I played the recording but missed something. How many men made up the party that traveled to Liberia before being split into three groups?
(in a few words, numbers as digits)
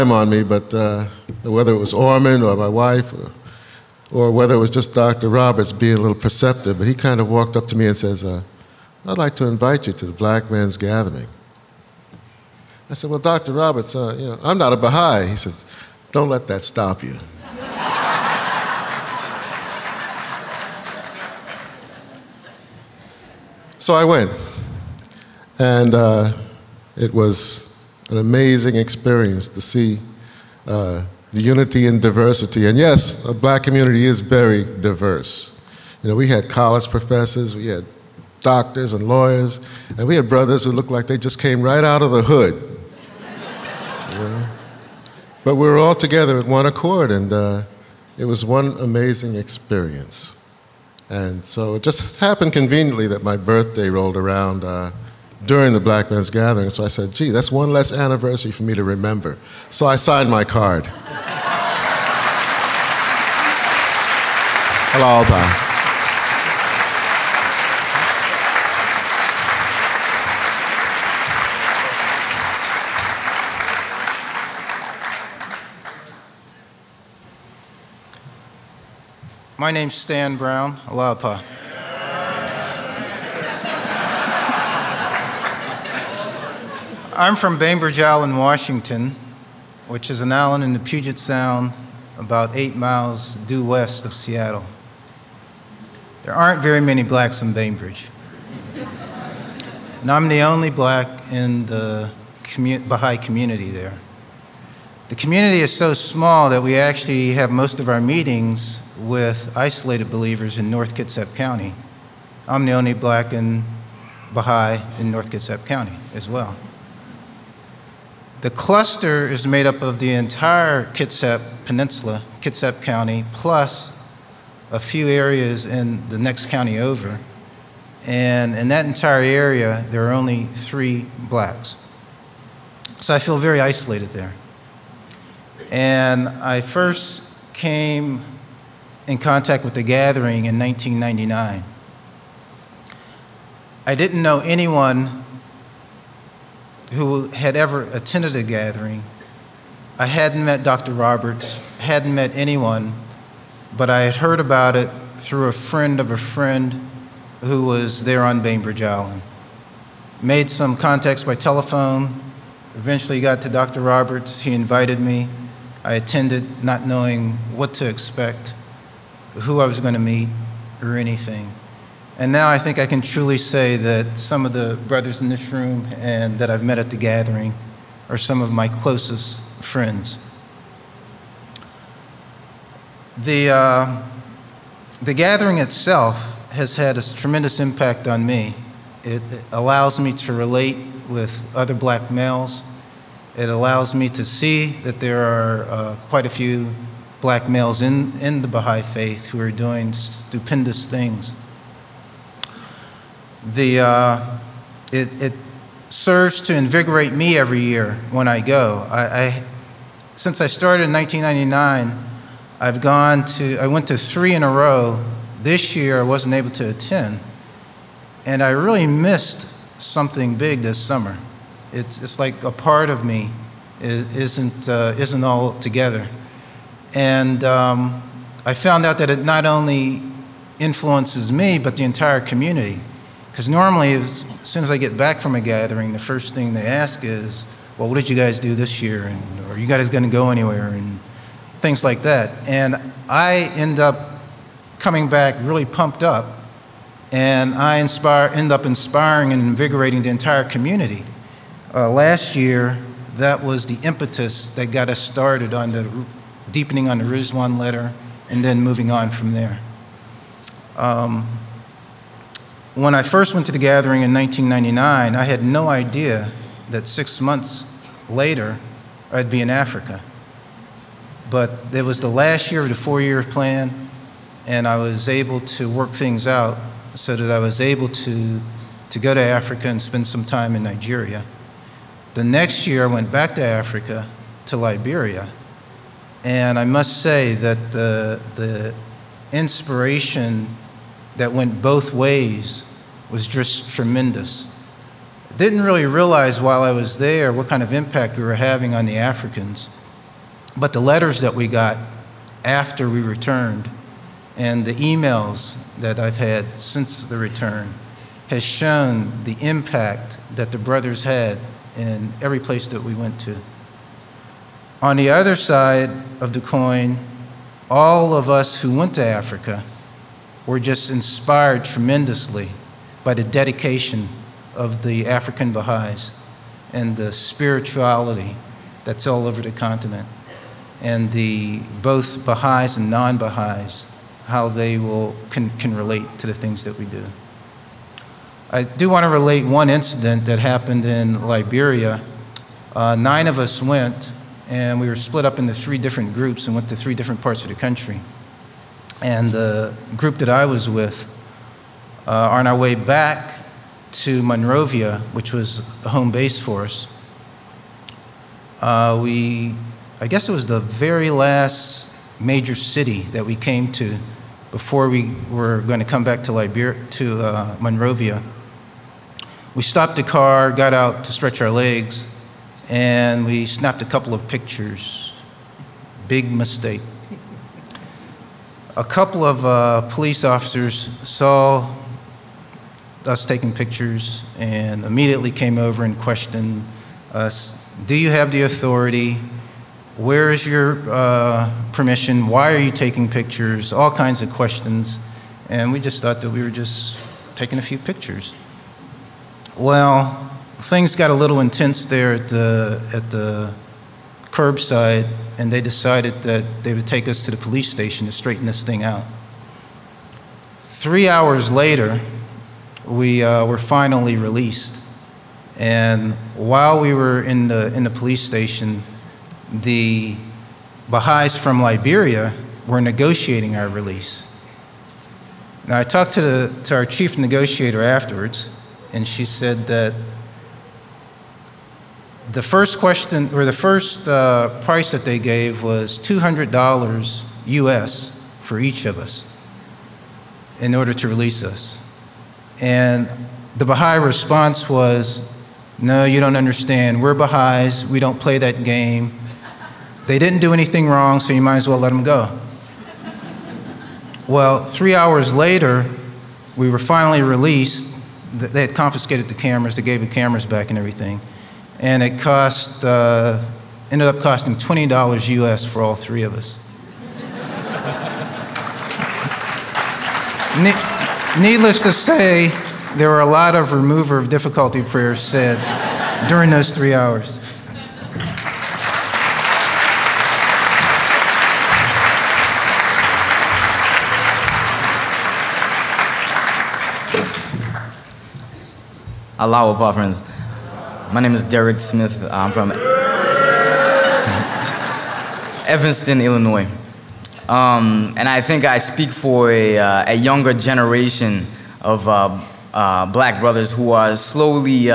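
9.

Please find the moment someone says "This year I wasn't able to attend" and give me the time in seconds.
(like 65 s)
215 s.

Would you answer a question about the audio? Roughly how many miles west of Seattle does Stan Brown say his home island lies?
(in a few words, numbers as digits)
8.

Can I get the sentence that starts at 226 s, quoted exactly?
And um, I found out that it not only influences me, but the entire community.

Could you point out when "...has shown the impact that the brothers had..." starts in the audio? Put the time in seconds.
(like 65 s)
308 s.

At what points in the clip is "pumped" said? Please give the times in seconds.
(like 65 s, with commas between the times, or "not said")
245 s.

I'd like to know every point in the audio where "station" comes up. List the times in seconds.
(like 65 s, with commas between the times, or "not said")
407 s, 418 s.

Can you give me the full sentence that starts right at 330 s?
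And the both Baha'is and non Baha'is, how they will, can, can relate to the things that we do.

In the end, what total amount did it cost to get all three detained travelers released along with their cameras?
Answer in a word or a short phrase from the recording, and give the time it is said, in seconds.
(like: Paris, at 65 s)
$20, at 464 s.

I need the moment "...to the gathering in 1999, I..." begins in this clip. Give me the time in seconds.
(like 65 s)
263 s.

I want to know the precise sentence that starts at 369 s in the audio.
We stopped the car, got out to stretch our legs, and we snapped a couple of pictures.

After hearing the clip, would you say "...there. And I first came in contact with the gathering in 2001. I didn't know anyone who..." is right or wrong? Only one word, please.
wrong.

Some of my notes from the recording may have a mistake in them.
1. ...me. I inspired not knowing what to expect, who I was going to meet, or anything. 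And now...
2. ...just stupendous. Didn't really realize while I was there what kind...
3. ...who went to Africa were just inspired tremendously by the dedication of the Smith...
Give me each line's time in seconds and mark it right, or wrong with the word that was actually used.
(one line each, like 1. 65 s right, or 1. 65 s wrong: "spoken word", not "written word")
1. 164 s wrong: "attended", not "inspired"
2. 293 s wrong: "tremendous", not "stupendous"
3. 318 s wrong: "African", not "Smith".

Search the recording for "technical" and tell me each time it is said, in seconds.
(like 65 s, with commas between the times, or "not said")
not said.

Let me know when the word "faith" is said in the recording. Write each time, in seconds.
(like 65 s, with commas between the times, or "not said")
198 s.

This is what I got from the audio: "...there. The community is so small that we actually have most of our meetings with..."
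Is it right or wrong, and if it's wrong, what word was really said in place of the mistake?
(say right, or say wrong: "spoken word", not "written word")
right.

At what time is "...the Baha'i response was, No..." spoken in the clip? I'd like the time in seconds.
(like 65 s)
443 s.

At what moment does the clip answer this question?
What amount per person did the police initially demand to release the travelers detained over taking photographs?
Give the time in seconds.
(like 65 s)
435 s.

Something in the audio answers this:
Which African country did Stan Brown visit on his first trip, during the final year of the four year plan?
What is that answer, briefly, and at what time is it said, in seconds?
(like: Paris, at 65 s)
Nigeria, at 280 s.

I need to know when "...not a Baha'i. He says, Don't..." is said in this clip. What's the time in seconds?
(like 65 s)
14 s.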